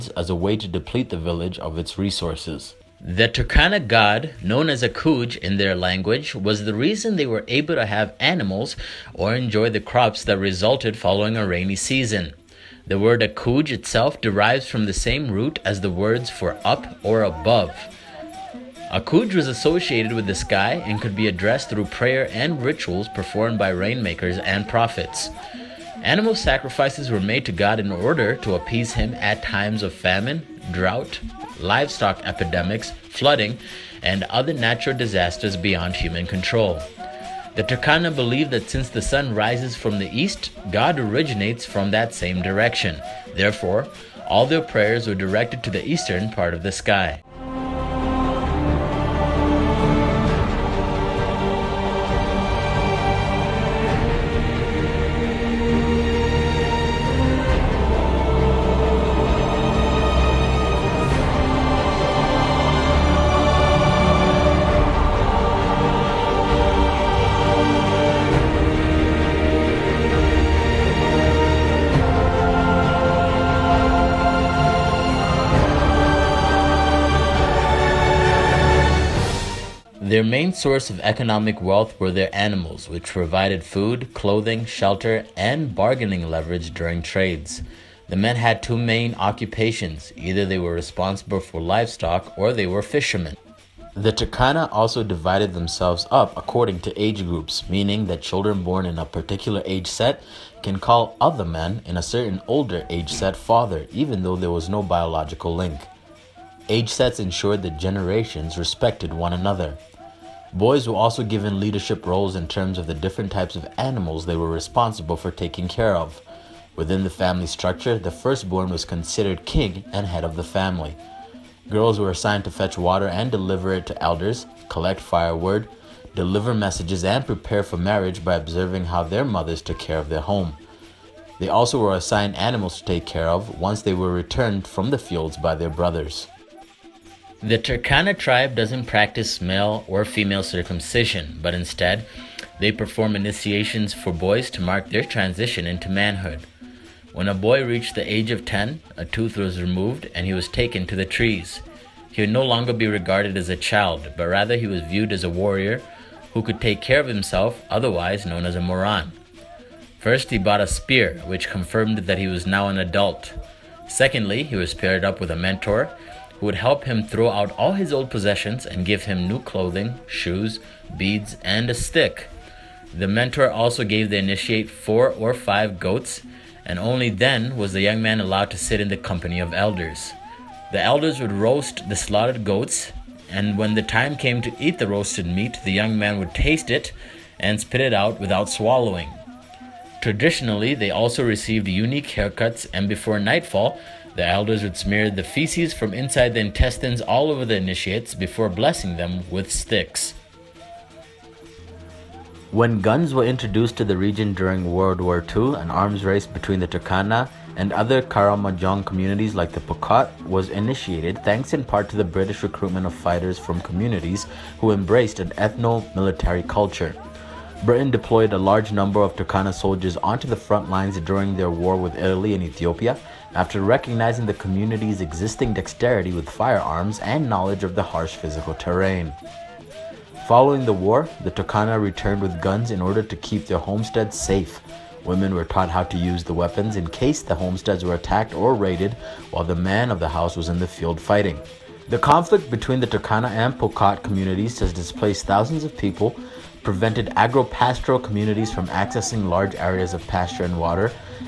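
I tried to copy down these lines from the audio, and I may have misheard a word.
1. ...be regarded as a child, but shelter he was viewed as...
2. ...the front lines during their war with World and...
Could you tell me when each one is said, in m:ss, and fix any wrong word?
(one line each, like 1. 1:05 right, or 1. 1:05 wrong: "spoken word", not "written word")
1. 2:32 wrong: "rather", not "shelter"
2. 3:40 wrong: "Italy", not "World".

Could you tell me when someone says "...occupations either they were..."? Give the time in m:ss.
1:29.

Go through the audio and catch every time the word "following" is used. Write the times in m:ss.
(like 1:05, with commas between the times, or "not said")
0:10, 3:50.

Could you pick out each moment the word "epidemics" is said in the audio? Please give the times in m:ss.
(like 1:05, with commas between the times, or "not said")
0:32.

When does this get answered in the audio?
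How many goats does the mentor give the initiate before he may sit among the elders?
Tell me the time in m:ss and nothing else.
2:54.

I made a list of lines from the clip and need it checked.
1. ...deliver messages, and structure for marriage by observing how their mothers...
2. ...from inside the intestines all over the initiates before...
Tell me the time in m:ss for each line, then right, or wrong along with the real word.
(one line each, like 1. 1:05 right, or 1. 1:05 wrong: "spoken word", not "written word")
1. 2:06 wrong: "prepare", not "structure"
2. 3:15 right.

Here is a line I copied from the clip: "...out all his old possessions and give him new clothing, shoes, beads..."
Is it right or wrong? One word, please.
right.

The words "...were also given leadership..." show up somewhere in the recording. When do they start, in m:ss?
1:50.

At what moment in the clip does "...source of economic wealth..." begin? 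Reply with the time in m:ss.
1:20.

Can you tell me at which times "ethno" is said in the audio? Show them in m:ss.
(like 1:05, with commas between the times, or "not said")
3:35.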